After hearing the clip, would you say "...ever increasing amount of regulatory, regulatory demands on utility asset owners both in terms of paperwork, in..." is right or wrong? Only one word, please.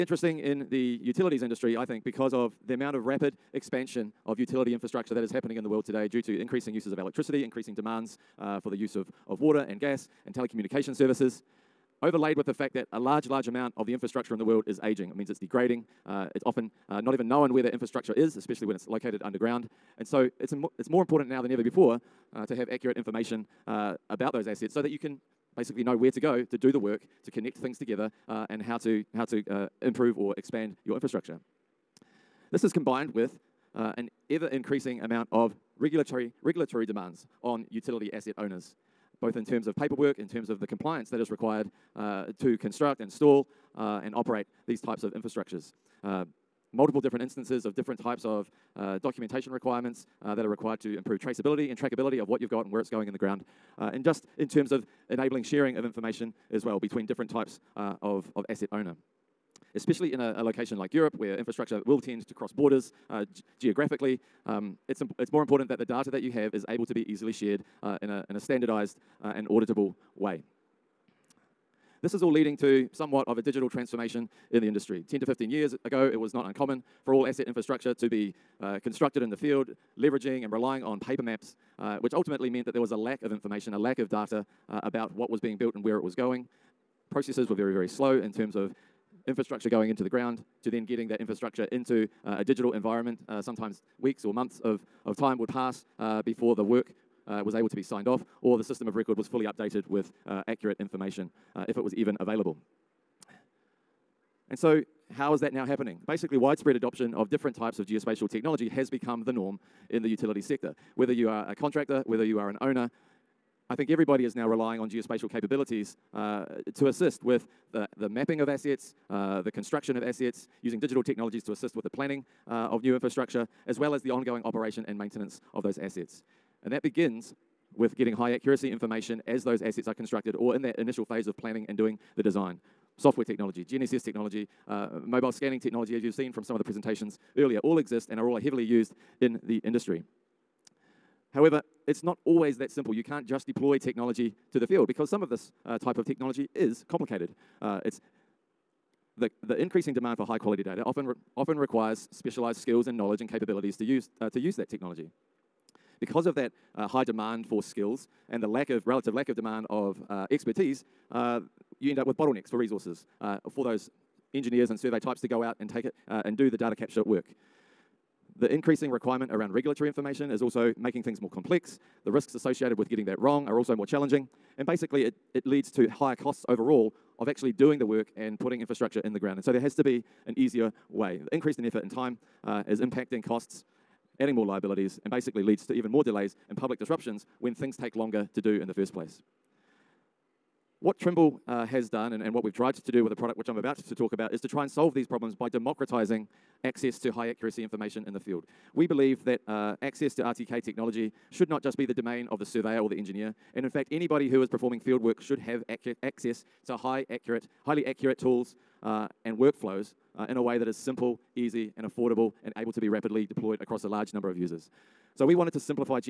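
right.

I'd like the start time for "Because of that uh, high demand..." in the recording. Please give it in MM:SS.
02:35.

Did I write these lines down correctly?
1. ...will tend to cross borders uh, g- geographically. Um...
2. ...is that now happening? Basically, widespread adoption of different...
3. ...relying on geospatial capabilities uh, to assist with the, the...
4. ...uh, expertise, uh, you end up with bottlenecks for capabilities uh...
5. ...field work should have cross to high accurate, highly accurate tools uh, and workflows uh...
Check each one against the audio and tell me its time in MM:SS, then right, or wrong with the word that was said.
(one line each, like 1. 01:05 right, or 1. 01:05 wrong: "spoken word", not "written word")
1. 01:01 right
2. 01:45 right
3. 01:54 right
4. 02:40 wrong: "resources", not "capabilities"
5. 03:24 wrong: "access", not "cross".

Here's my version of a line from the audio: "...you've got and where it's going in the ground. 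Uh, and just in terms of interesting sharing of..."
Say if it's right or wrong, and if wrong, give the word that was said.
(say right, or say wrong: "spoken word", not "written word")
wrong: "enabling", not "interesting".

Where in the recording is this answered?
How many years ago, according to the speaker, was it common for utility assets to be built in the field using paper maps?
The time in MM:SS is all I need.
01:15.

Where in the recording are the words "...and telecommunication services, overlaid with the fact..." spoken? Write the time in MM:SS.
00:10.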